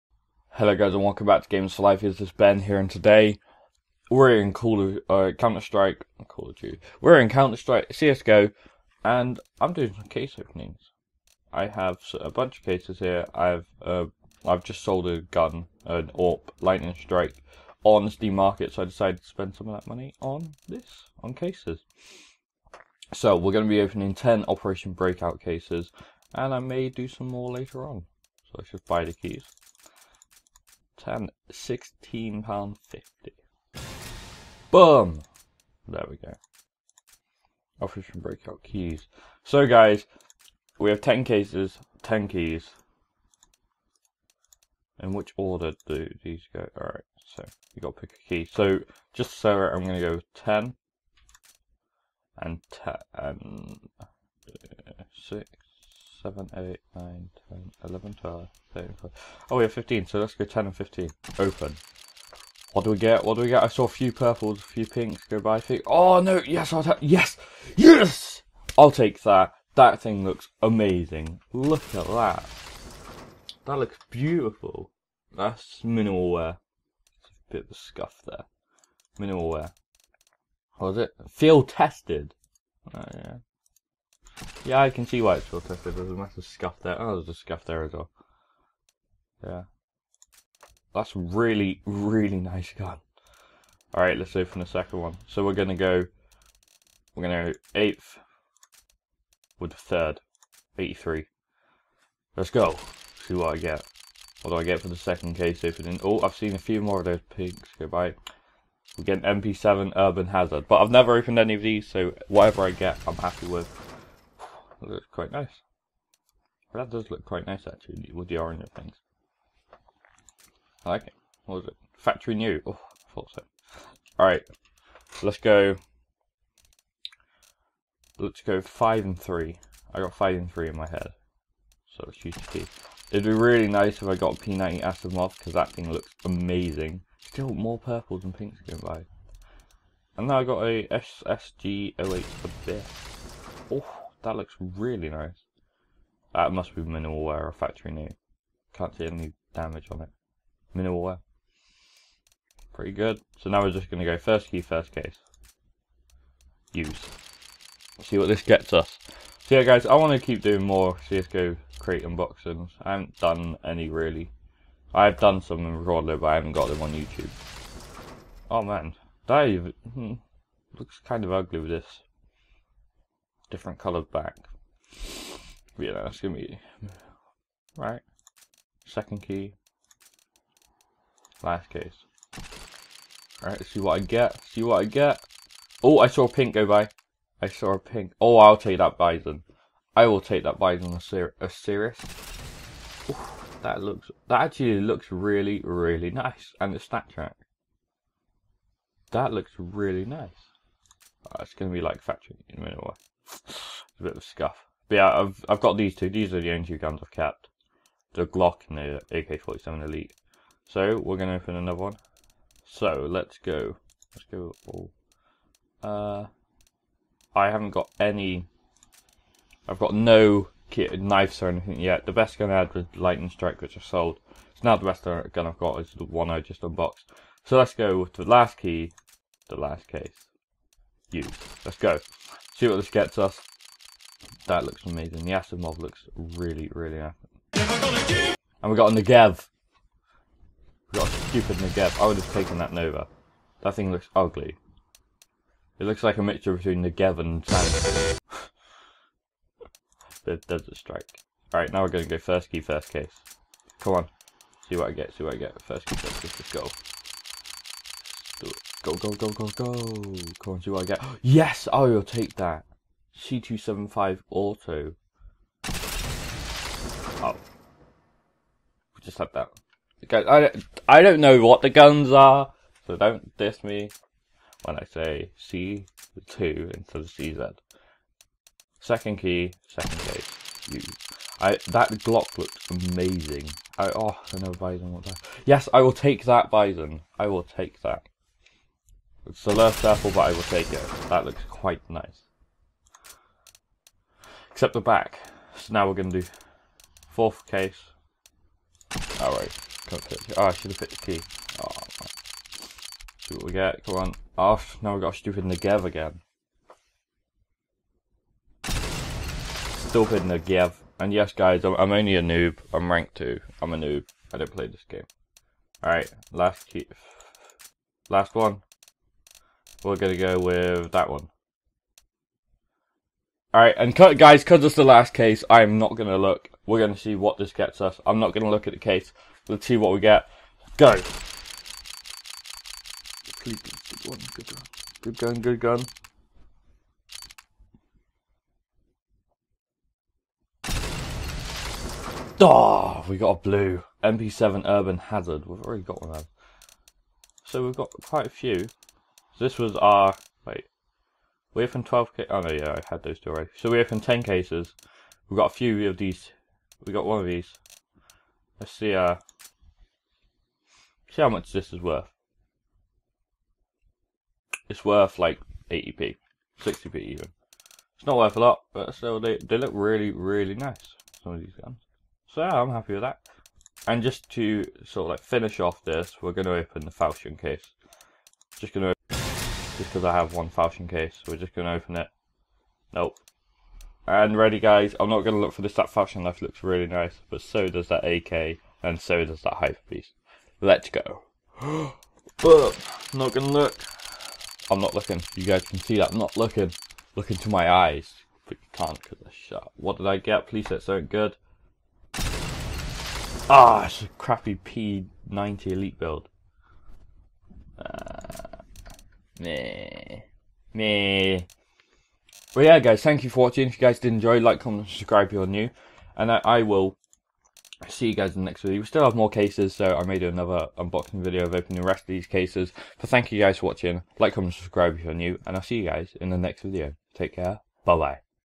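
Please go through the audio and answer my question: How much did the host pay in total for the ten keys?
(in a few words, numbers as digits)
16 pounds 50.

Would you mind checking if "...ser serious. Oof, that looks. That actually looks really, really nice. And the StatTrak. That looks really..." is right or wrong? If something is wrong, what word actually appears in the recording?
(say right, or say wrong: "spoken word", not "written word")
right.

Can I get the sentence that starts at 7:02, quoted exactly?
But thank you guys for watching.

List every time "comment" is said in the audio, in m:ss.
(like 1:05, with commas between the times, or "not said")
6:54, 7:04.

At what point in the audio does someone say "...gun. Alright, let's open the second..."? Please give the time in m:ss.
1:32.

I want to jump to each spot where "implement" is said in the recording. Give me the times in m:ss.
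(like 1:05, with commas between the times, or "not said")
not said.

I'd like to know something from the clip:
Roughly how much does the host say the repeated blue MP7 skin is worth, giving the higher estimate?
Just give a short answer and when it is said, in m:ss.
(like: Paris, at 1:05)
80p, at 6:05.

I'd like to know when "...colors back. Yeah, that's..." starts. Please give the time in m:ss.
2:53.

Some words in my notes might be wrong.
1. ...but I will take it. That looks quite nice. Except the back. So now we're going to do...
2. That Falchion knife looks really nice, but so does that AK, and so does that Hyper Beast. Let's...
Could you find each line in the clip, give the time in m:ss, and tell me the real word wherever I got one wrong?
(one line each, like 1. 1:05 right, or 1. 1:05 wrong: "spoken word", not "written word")
1. 4:50 right
2. 6:25 right.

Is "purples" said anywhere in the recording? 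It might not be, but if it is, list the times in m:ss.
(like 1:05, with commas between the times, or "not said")
1:04, 2:17.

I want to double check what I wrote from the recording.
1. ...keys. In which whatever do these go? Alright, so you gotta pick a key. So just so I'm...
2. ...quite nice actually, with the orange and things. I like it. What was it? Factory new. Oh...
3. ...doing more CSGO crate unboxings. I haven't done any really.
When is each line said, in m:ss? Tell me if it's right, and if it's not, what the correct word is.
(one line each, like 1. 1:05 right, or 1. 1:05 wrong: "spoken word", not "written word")
1. 0:42 wrong: "order", not "whatever"
2. 1:57 right
3. 2:40 right.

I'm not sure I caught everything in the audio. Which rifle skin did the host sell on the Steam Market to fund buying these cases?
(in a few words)
AWP Lightning Strike.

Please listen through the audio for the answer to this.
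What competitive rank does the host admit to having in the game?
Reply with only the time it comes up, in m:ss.
5:12.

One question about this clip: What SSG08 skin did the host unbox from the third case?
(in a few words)
Abyss.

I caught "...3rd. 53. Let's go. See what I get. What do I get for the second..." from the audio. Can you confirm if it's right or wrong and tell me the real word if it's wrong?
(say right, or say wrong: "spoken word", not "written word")
wrong: "83", not "53".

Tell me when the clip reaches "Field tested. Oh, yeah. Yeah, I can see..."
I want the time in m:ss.
1:21.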